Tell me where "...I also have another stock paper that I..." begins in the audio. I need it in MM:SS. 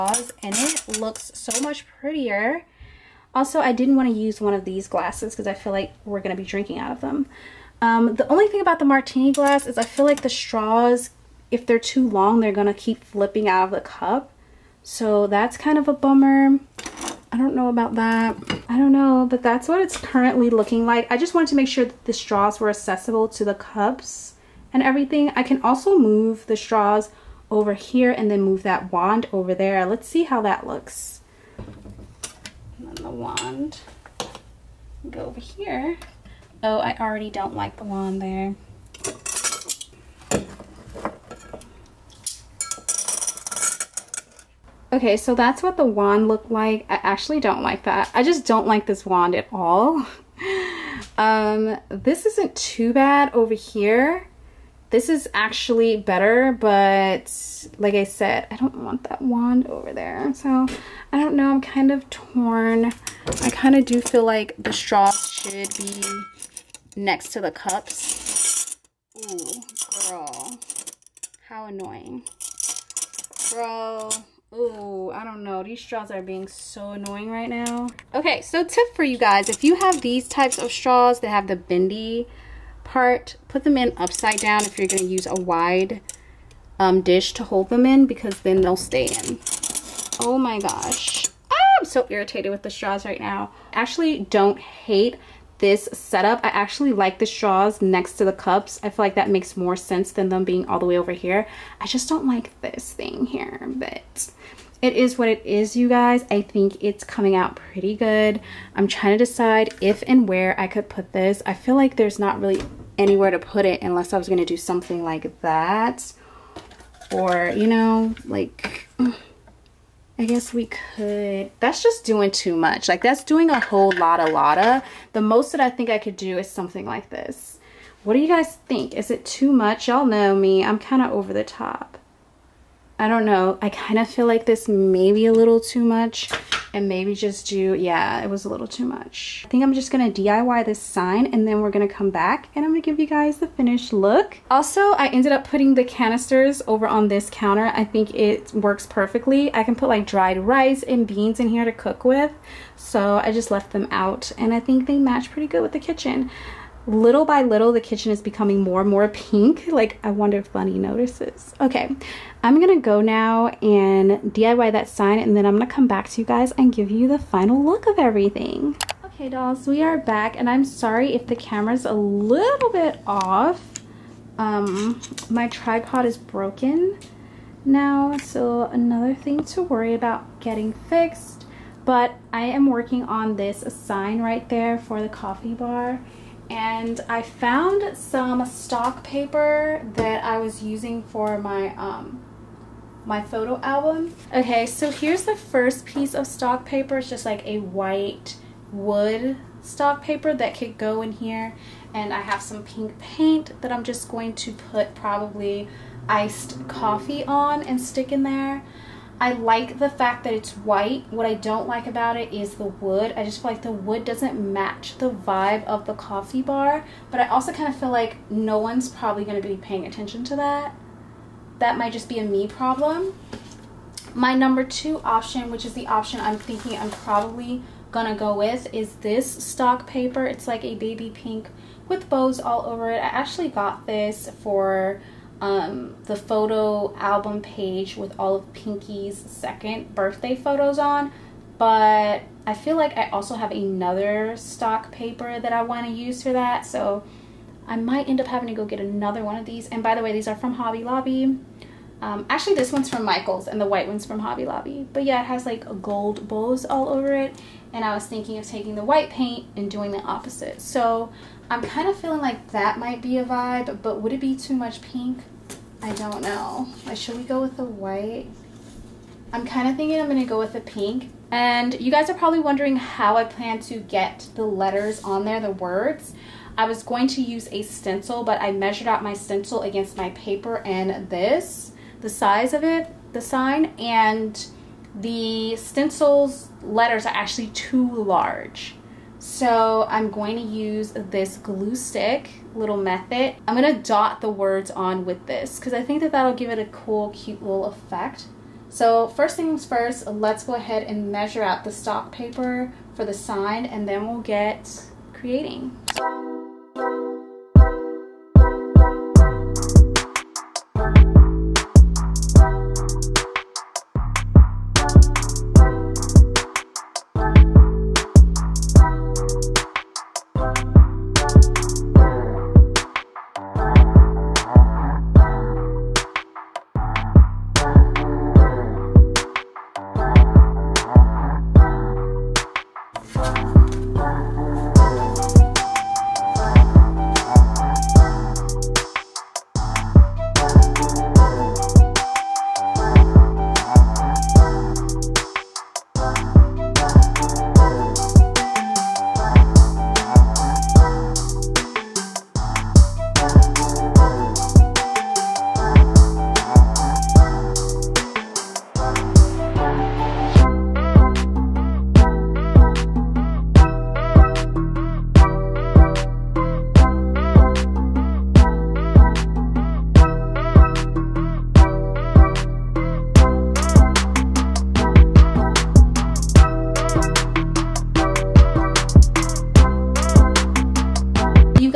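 04:02.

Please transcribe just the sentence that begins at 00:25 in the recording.
I can also move the straws over here and then move that wand over there.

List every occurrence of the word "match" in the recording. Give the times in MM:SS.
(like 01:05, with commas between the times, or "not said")
02:34, 03:34.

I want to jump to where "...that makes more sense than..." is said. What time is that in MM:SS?
01:39.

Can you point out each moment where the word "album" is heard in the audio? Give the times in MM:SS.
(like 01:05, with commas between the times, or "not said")
03:13, 03:56.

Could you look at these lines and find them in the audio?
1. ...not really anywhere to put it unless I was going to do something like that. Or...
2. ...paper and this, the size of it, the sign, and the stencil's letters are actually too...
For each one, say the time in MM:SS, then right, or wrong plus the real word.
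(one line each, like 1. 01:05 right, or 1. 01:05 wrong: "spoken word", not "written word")
1. 01:52 right
2. 04:40 right.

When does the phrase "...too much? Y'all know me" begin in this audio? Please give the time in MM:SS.
02:09.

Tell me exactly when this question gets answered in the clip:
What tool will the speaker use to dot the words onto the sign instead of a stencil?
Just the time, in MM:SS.
04:51.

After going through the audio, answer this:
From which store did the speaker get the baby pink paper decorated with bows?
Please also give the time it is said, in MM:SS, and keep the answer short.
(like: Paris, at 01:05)
Michaels, at 04:13.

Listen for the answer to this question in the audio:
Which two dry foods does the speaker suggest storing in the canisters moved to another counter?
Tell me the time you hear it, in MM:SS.
02:30.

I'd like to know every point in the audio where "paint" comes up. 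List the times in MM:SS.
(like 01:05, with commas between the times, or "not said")
03:22, 04:19.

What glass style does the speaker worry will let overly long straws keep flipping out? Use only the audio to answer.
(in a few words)
Martini glass.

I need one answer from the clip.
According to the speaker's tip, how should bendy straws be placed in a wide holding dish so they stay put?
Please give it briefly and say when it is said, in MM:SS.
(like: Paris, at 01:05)
Upside down, at 01:23.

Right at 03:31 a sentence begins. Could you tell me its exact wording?
What I don't like about it is the wood.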